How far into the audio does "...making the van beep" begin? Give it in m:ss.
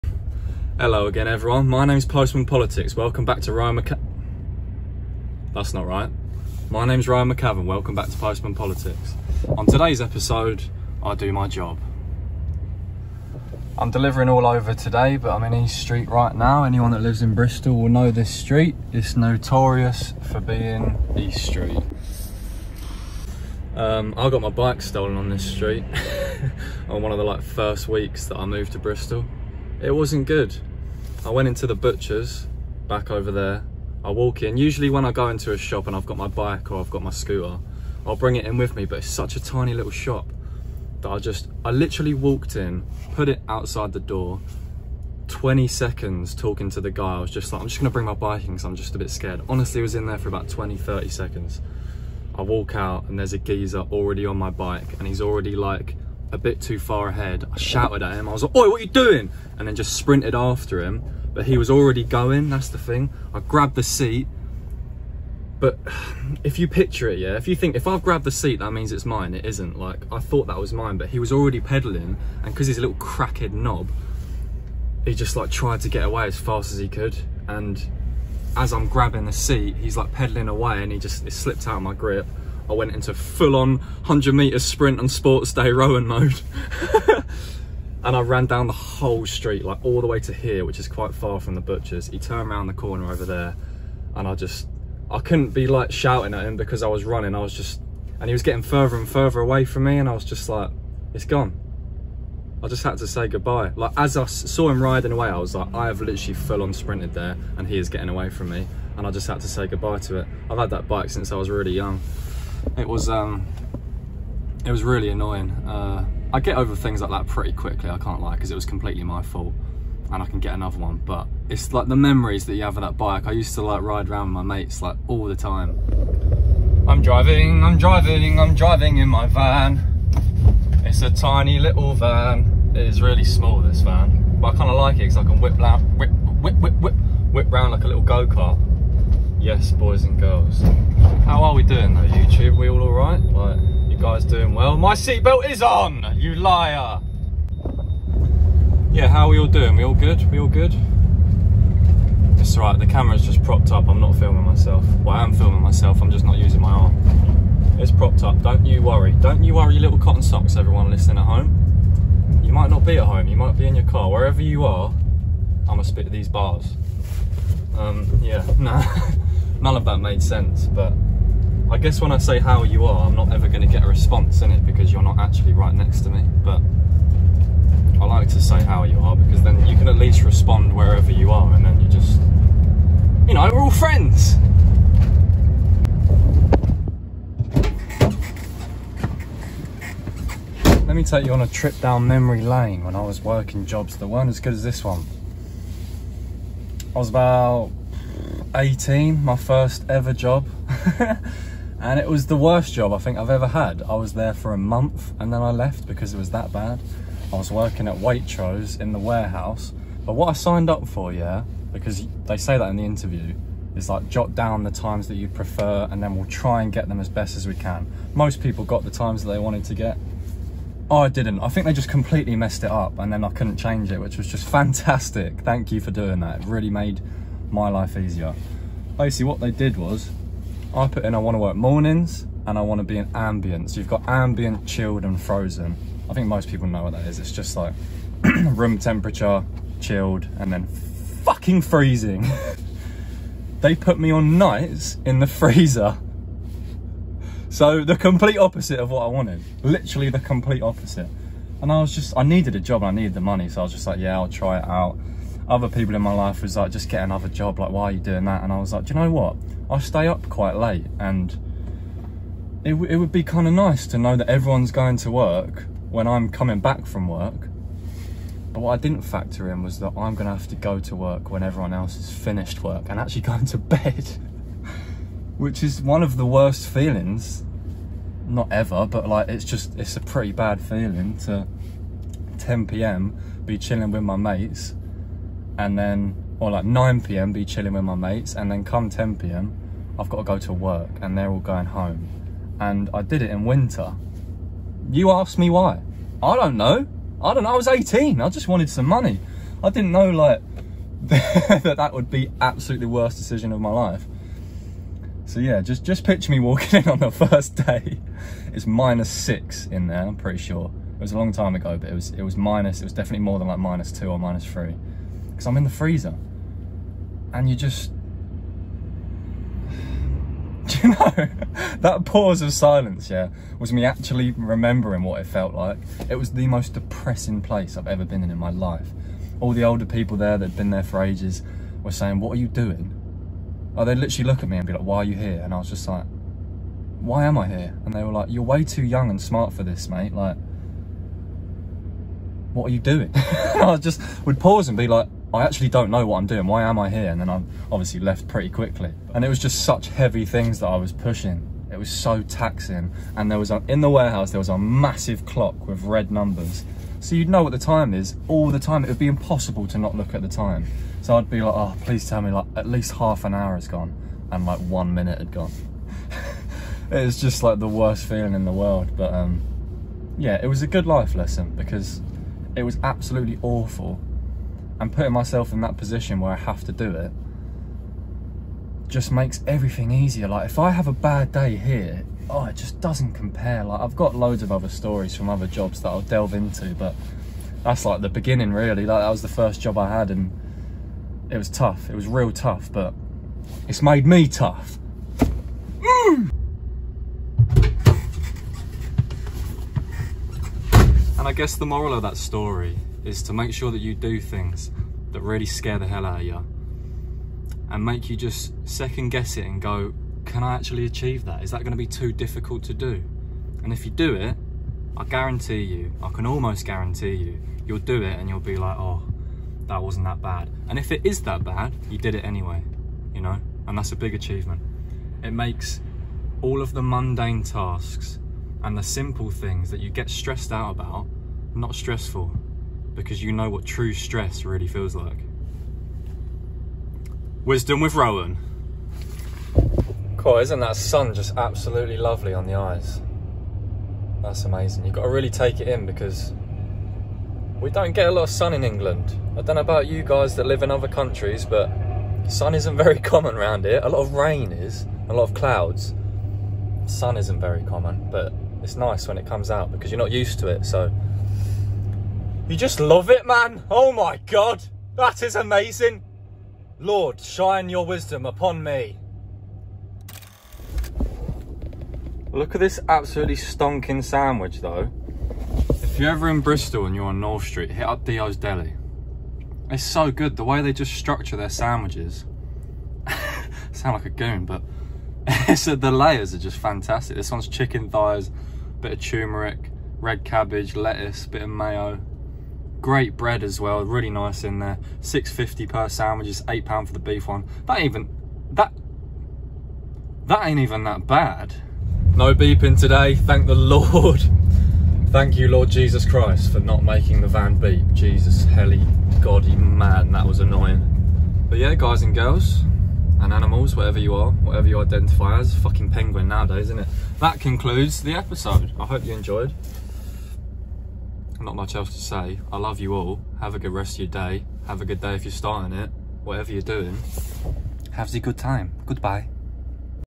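8:26.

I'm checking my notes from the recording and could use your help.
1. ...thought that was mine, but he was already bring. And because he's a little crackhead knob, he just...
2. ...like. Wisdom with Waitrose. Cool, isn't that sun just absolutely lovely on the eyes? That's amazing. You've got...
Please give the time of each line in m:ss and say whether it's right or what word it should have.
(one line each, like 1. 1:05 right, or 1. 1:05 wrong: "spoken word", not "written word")
1. 1:10 wrong: "pedaling", not "bring"
2. 7:14 wrong: "Rowan", not "Waitrose".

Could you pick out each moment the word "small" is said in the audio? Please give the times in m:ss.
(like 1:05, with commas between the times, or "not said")
2:13.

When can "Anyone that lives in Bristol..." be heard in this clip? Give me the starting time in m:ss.
0:16.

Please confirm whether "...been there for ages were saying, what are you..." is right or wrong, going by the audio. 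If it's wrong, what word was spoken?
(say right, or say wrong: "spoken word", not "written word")
right.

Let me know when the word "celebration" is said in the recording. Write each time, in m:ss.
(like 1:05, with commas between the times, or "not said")
not said.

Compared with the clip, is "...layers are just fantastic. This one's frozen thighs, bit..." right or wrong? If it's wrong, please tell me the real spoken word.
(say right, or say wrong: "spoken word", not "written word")
wrong: "chicken", not "frozen".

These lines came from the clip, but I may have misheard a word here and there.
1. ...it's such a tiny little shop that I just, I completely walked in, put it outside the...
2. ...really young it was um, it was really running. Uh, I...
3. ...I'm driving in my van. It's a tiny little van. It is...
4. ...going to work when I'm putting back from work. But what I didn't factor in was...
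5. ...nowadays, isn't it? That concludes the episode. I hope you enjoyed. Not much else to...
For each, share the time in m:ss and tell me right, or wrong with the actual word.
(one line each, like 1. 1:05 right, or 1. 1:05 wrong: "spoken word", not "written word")
1. 0:38 wrong: "literally", not "completely"
2. 1:51 wrong: "annoying", not "running"
3. 2:08 right
4. 4:24 wrong: "coming", not "putting"
5. 8:36 right.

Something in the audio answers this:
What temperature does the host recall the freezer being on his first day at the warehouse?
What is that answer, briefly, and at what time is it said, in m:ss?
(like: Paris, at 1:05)
minus 6, at 5:08.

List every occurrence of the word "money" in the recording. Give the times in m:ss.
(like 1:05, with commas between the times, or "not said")
4:13, 4:58.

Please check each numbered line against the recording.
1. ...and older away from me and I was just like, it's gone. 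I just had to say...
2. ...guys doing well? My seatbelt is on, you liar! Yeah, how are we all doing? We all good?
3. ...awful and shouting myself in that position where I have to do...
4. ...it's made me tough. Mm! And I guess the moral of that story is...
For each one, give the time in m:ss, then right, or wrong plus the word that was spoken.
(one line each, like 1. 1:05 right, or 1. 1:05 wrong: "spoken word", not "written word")
1. 1:38 wrong: "further", not "older"
2. 2:23 right
3. 6:13 wrong: "putting", not "shouting"
4. 6:33 right.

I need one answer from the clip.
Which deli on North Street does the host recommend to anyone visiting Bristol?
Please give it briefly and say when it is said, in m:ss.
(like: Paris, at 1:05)
Dio's Deli, at 7:58.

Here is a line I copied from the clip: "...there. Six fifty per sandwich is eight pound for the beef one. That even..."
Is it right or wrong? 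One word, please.
right.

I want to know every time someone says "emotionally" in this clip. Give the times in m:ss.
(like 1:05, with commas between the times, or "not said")
not said.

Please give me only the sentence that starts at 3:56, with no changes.
I think most people know what that is.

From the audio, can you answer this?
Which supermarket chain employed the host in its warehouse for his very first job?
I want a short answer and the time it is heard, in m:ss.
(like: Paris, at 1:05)
Waitrose, at 3:27.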